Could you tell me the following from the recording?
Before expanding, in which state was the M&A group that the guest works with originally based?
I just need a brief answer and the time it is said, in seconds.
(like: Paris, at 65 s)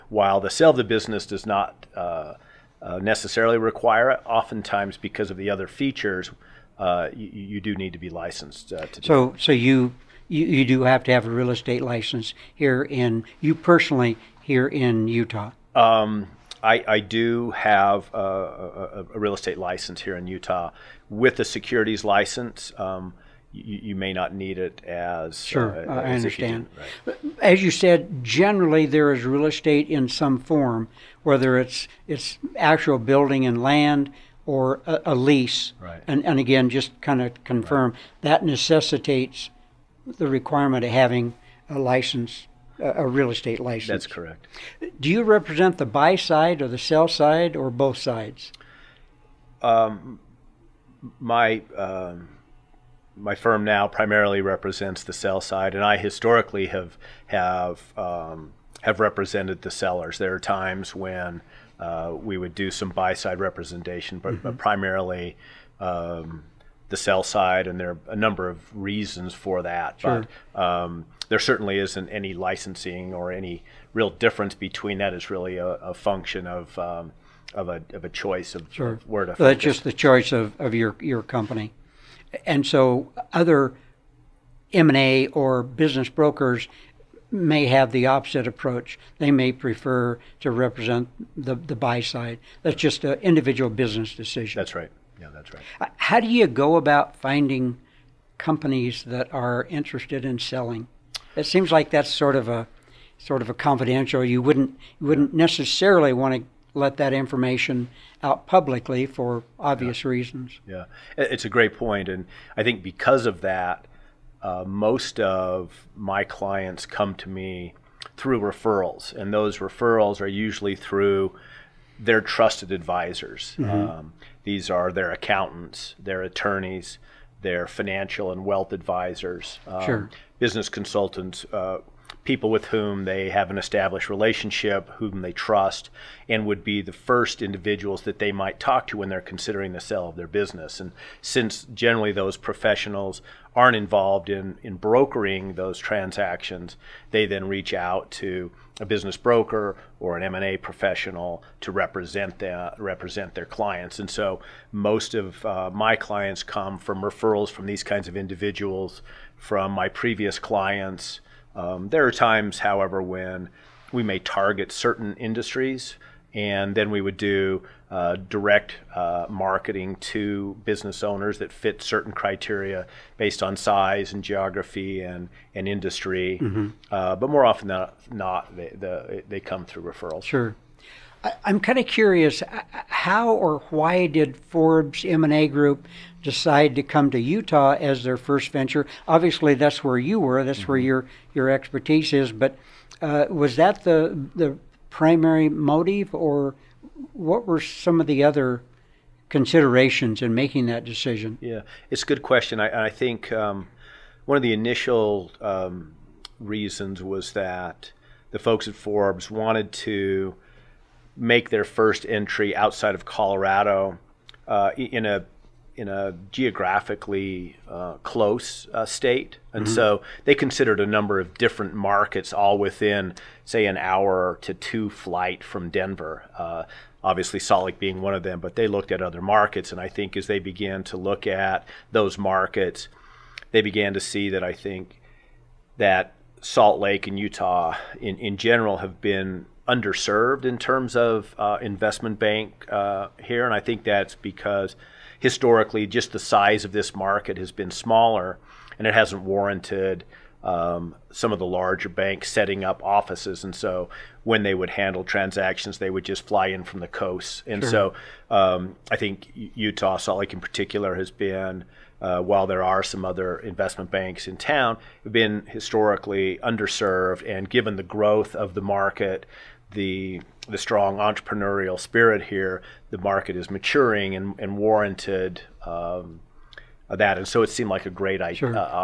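Colorado, at 213 s.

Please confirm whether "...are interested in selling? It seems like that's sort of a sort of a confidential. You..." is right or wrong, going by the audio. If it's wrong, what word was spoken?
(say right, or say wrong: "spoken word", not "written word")
right.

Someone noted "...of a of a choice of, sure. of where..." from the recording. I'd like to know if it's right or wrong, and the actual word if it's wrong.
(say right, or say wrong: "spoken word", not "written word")
right.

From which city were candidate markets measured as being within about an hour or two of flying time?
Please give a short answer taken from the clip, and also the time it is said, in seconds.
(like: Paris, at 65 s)
Denver, at 225 s.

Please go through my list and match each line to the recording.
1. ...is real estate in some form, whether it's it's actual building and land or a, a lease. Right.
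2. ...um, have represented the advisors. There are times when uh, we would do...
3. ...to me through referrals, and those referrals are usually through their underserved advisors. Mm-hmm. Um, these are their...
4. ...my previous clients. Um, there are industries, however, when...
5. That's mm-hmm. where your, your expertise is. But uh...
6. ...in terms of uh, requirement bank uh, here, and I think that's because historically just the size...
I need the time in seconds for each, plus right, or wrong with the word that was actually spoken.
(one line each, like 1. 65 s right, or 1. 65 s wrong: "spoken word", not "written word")
1. 29 s right
2. 57 s wrong: "sellers", not "advisors"
3. 117 s wrong: "trusted", not "underserved"
4. 159 s wrong: "times", not "industries"
5. 190 s right
6. 240 s wrong: "investment", not "requirement".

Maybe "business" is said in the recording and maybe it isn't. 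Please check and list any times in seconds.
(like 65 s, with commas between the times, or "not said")
0 s, 85 s, 93 s, 130 s, 140 s, 148 s, 170 s.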